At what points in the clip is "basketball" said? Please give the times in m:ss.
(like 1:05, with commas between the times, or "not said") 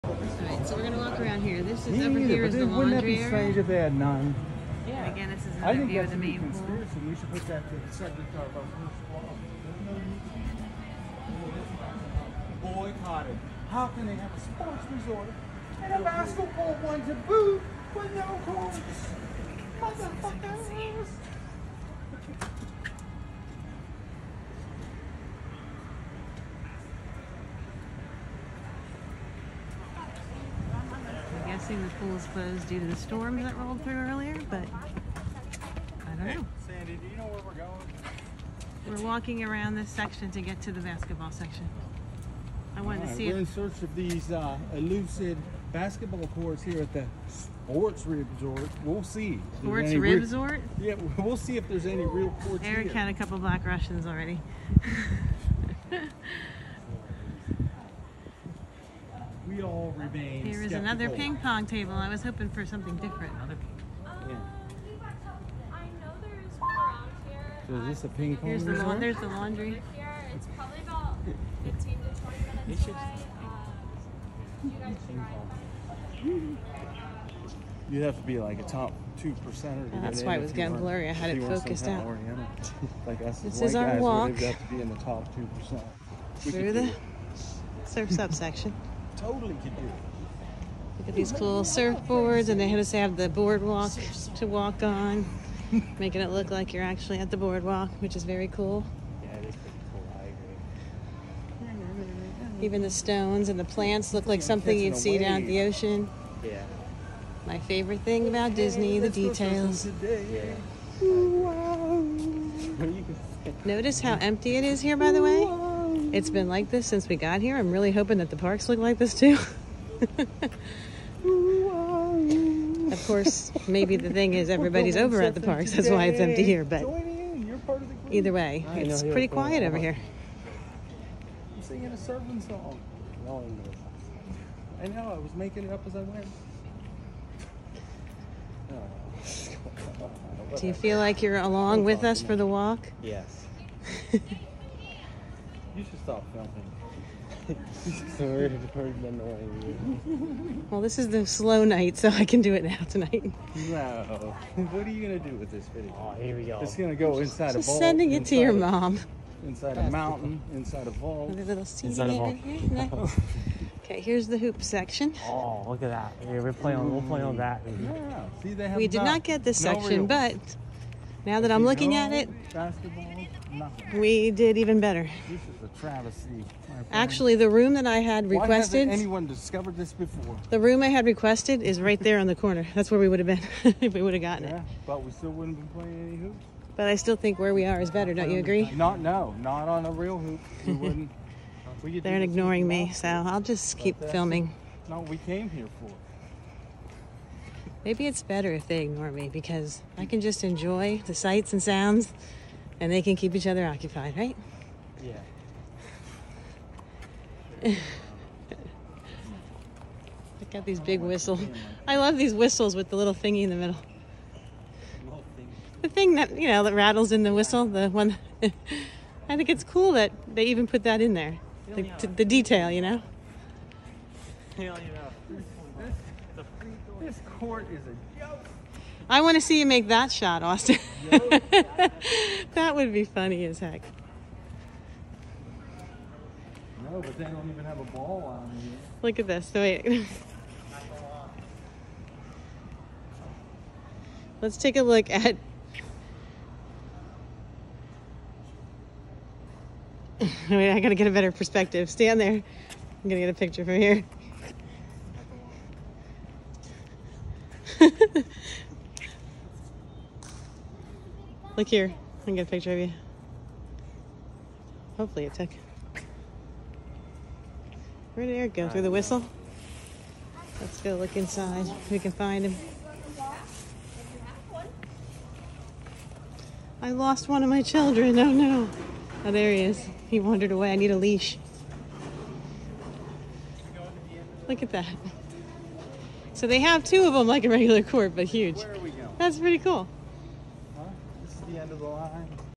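0:16, 0:40, 0:45, 2:52.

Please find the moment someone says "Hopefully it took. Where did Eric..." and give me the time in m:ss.
4:24.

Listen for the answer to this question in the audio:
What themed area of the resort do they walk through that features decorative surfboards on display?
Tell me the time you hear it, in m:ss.
1:27.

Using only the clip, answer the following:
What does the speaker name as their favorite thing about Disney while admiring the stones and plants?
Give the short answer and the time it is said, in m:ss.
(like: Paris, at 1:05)
the details, at 1:48.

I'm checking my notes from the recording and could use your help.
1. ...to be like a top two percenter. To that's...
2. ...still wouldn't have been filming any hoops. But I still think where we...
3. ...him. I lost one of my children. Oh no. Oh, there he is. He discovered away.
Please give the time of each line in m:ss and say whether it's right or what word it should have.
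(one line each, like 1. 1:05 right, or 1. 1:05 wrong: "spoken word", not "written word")
1. 1:18 right
2. 3:05 wrong: "playing", not "filming"
3. 4:32 wrong: "wandered", not "discovered".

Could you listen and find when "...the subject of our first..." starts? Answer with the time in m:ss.
0:07.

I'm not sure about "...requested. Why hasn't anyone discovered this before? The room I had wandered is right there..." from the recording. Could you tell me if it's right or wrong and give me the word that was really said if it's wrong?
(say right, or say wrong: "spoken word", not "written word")
wrong: "requested", not "wandered".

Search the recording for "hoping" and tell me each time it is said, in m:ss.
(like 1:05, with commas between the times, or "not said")
1:02, 1:57.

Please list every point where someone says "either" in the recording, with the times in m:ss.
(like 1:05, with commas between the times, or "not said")
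0:02, 2:08.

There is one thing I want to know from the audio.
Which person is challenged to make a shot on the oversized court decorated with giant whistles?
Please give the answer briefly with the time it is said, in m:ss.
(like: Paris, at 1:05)
Austin, at 3:50.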